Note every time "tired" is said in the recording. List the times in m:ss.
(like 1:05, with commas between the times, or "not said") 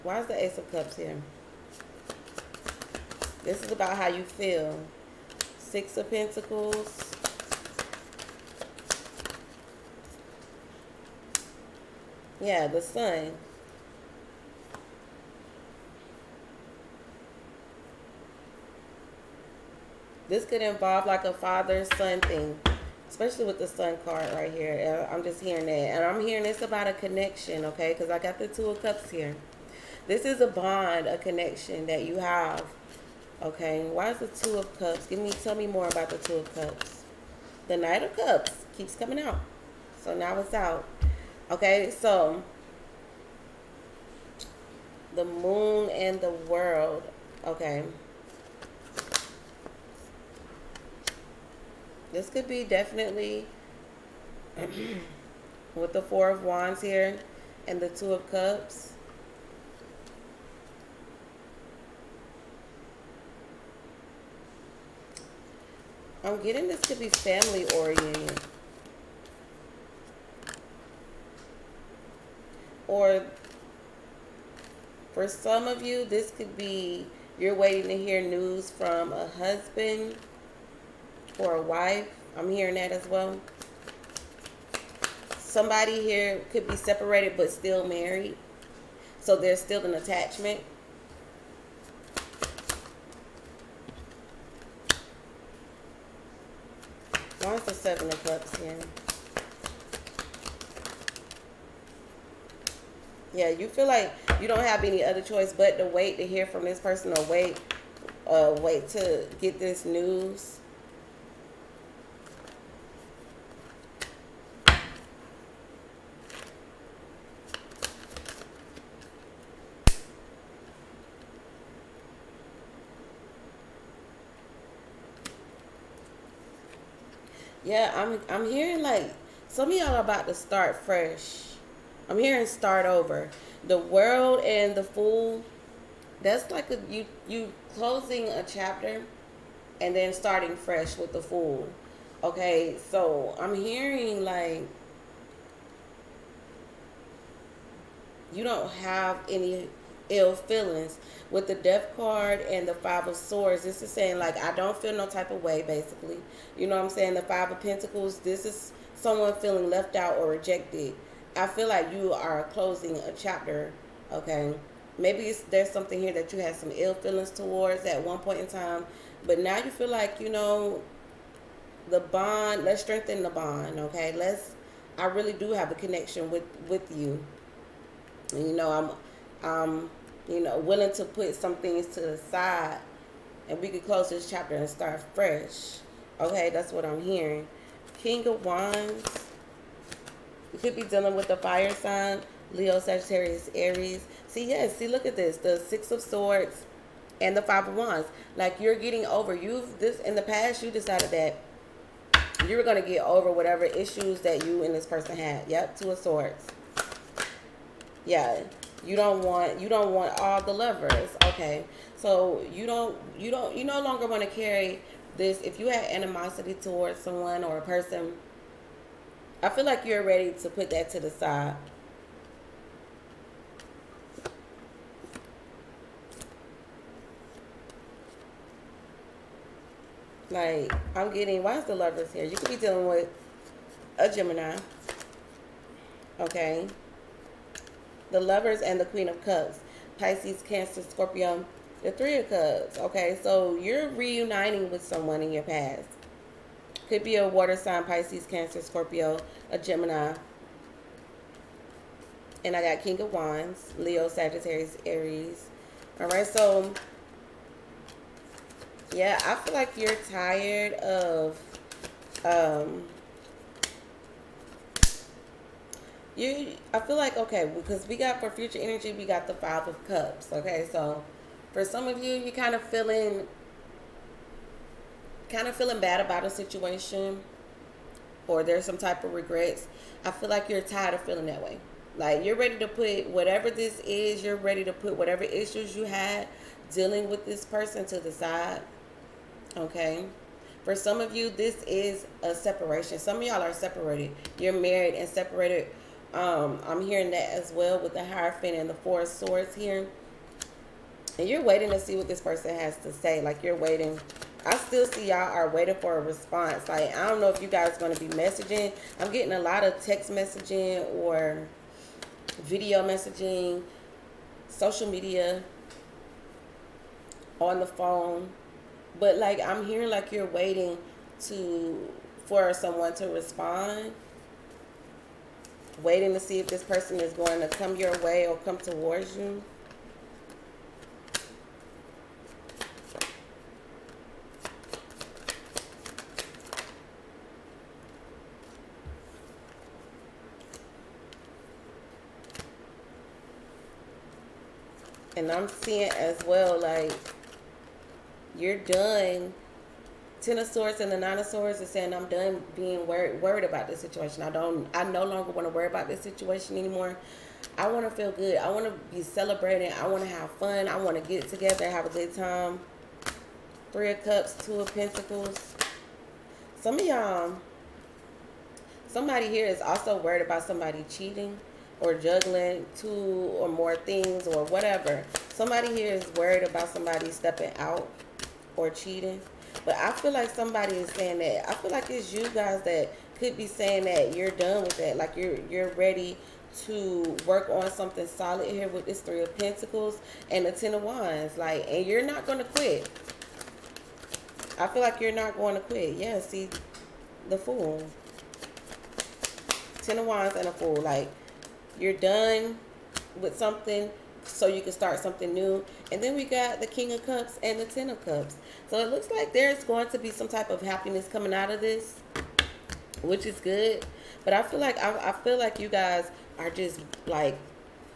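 4:20, 4:40.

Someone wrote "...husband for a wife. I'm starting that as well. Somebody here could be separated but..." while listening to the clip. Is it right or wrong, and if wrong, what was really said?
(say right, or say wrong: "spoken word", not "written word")
wrong: "hearing", not "starting".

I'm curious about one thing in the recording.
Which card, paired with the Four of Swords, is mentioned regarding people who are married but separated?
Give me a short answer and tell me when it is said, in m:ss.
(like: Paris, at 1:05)
Hierophant, at 4:58.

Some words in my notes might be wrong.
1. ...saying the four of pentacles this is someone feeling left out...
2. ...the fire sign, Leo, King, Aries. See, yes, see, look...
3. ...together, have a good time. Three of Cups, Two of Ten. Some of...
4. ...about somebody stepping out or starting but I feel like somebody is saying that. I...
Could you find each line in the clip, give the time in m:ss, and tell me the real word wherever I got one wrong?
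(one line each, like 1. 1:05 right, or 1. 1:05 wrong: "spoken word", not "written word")
1. 2:36 wrong: "five", not "four"
2. 3:11 wrong: "Sagittarius", not "King"
3. 6:01 wrong: "Pentacles", not "Ten"
4. 6:16 wrong: "cheating", not "starting".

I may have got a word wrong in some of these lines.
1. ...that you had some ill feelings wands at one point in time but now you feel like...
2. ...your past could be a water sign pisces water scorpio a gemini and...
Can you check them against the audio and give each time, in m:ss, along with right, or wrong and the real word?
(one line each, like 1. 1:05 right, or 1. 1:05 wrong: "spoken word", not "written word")
1. 2:46 wrong: "towards", not "wands"
2. 4:05 wrong: "cancer", not "water".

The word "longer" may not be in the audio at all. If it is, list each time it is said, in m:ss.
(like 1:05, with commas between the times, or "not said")
3:33, 5:55.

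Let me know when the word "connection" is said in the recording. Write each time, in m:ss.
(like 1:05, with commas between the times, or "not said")
0:26, 0:31, 2:55.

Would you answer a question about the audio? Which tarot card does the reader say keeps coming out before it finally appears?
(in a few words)
Knight of Cups.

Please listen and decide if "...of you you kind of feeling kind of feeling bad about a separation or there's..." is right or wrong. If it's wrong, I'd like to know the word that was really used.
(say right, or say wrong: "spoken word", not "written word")
wrong: "situation", not "separation".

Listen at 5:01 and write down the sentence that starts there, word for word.
And you're waiting to see what this person has to say.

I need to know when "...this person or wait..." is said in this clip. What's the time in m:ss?
1:46.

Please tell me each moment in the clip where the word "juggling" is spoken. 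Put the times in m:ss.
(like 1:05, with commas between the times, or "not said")
6:11.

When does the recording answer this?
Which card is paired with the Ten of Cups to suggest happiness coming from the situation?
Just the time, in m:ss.
6:46.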